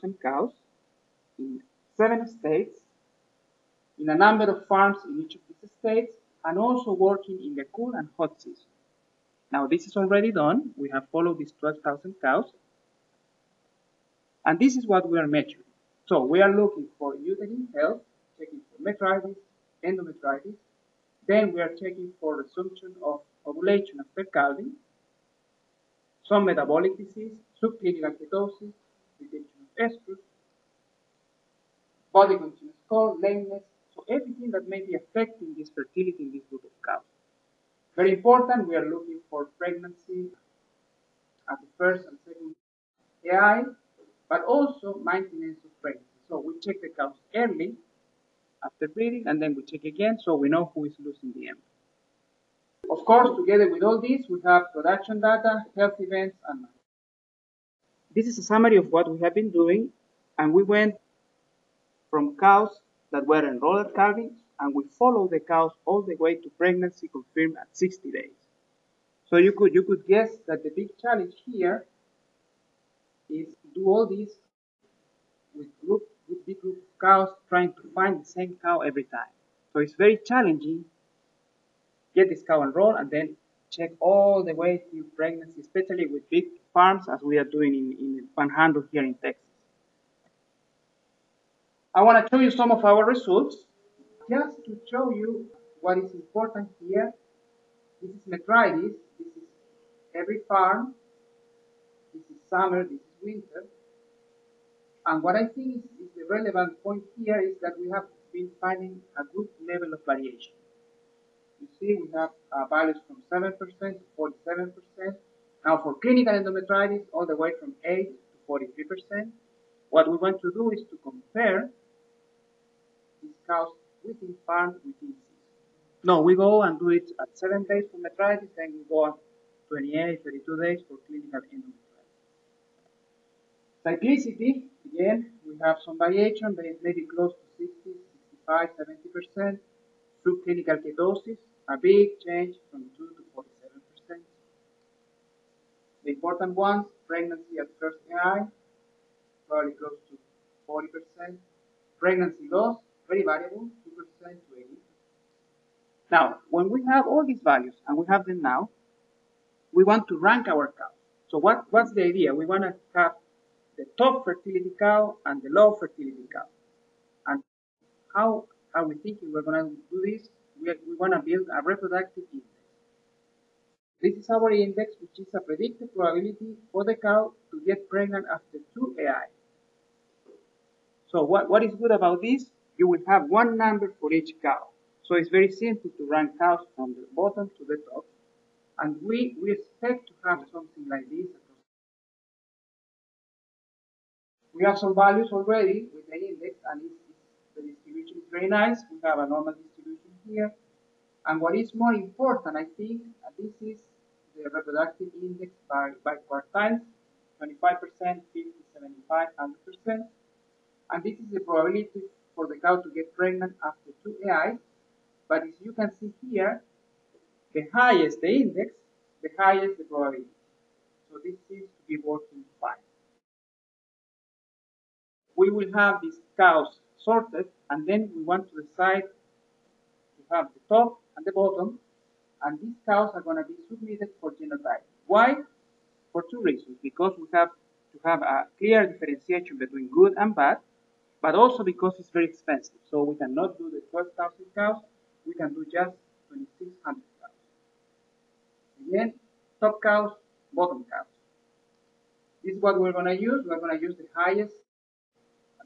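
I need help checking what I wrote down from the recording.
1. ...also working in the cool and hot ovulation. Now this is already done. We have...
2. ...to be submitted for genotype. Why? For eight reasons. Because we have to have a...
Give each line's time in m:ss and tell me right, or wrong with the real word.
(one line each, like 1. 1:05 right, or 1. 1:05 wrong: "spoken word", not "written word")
1. 0:06 wrong: "season", not "ovulation"
2. 3:53 wrong: "two", not "eight".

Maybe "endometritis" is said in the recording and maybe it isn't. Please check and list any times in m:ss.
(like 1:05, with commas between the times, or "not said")
0:19, 1:56, 2:11.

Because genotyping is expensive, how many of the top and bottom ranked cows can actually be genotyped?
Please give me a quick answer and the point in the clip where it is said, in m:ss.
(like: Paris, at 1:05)
2,600, at 4:06.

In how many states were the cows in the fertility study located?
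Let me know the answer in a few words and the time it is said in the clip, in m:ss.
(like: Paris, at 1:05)
7, at 0:01.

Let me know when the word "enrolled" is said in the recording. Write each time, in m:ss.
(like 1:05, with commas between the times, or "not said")
1:03, 1:22.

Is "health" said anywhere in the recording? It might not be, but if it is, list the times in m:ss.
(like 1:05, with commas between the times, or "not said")
0:17, 0:55.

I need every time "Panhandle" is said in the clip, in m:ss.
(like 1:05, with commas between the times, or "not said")
1:28.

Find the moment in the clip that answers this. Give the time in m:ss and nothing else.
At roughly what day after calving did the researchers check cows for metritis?
2:07.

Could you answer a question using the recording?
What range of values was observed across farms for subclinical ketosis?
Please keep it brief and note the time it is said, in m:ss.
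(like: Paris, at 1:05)
2 to 47%, at 2:22.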